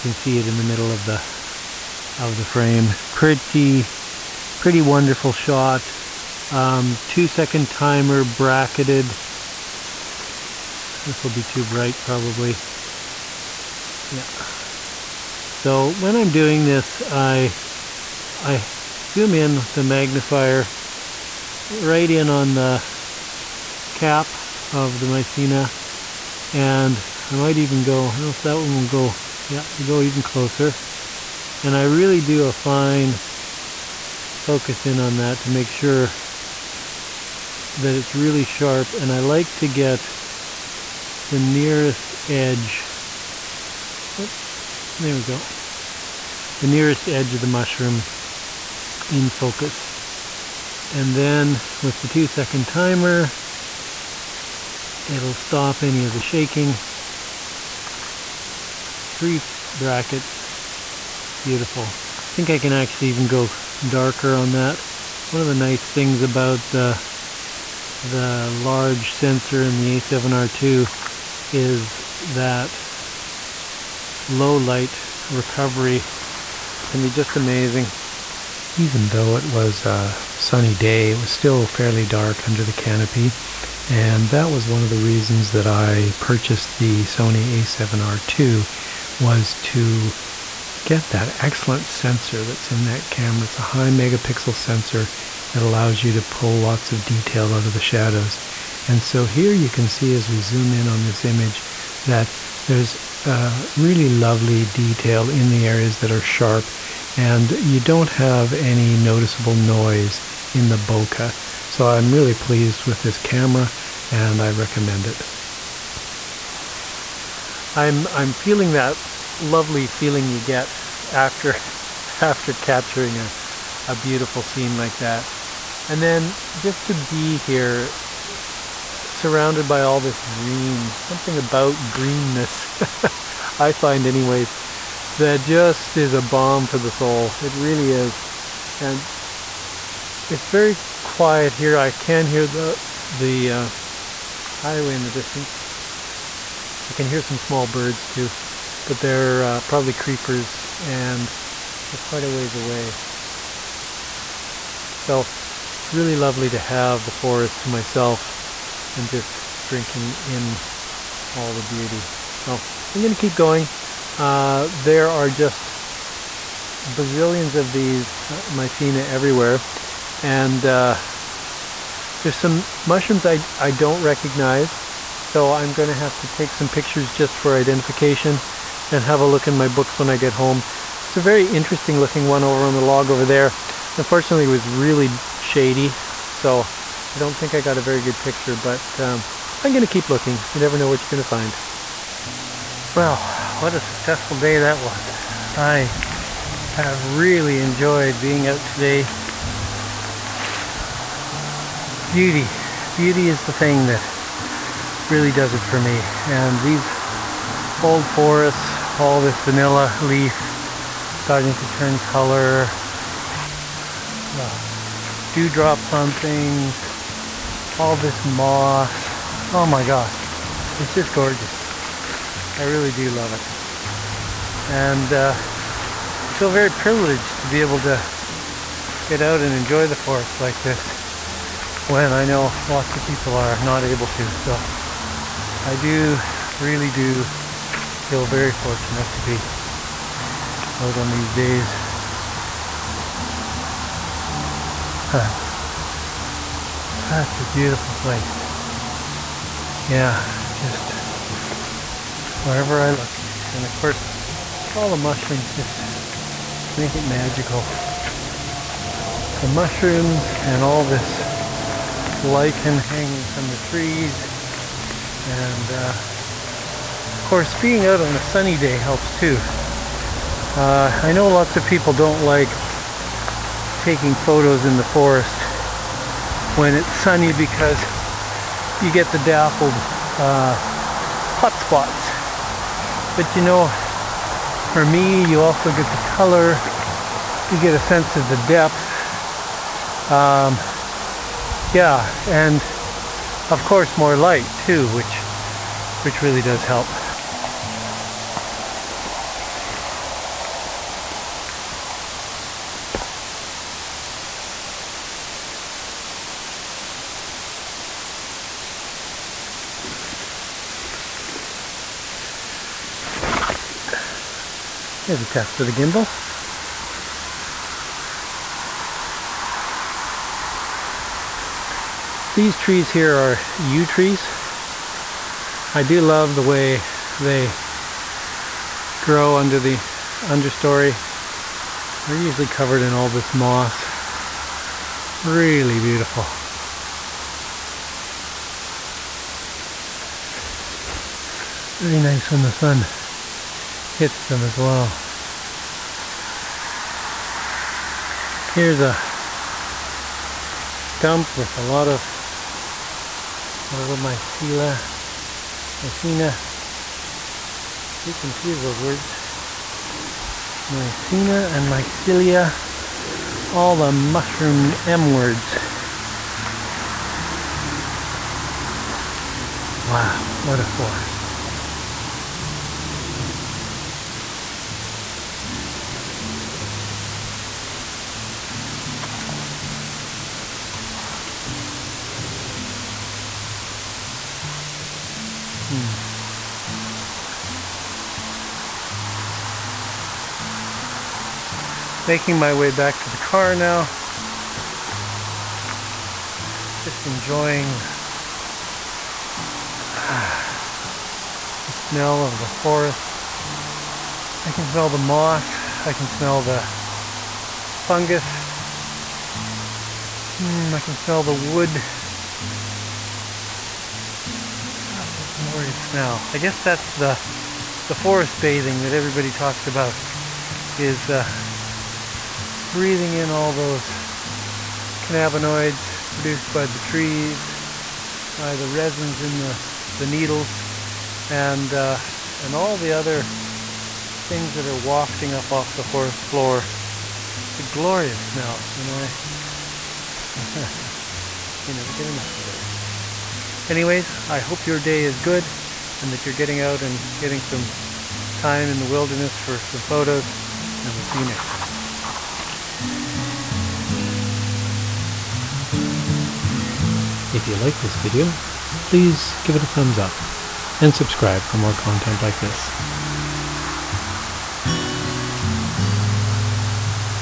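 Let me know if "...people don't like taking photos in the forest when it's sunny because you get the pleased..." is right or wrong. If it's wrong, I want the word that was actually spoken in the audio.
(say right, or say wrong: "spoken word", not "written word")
wrong: "dappled", not "pleased".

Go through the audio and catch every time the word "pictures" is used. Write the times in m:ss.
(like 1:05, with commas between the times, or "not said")
2:56, 3:08.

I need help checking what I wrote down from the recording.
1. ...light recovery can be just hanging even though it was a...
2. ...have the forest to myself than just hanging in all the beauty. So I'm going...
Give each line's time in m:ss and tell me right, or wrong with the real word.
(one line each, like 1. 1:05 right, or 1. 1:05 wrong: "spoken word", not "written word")
1. 1:14 wrong: "amazing", not "hanging"
2. 2:36 wrong: "drinking", not "hanging".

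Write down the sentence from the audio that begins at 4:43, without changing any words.
But you know, for me, you also get the color, you get a sense of the depth.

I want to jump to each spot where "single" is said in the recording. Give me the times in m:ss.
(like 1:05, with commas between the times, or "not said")
not said.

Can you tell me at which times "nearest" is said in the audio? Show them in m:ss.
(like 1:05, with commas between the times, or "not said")
0:41, 0:46.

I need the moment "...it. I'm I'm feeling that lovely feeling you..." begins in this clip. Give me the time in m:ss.
1:55.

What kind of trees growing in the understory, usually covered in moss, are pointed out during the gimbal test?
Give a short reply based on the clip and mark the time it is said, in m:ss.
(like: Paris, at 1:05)
Yew trees, at 5:23.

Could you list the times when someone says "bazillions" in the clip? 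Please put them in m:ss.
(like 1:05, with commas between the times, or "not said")
2:46.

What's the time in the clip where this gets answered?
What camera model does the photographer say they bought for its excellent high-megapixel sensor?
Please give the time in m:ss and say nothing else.
1:27.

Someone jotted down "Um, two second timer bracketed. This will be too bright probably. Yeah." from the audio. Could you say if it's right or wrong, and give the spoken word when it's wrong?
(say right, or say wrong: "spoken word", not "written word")
right.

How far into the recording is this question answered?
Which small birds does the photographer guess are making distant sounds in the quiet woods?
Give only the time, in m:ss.
2:29.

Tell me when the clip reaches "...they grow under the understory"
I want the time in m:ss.
5:27.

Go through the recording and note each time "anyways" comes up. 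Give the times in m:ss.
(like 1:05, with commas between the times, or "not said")
2:14, 7:23.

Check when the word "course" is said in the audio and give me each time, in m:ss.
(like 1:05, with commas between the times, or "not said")
4:13, 4:27, 4:53.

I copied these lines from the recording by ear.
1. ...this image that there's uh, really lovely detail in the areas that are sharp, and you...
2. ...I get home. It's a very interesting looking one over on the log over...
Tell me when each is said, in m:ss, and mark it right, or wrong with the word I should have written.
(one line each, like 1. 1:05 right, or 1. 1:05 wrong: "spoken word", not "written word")
1. 1:41 right
2. 3:00 right.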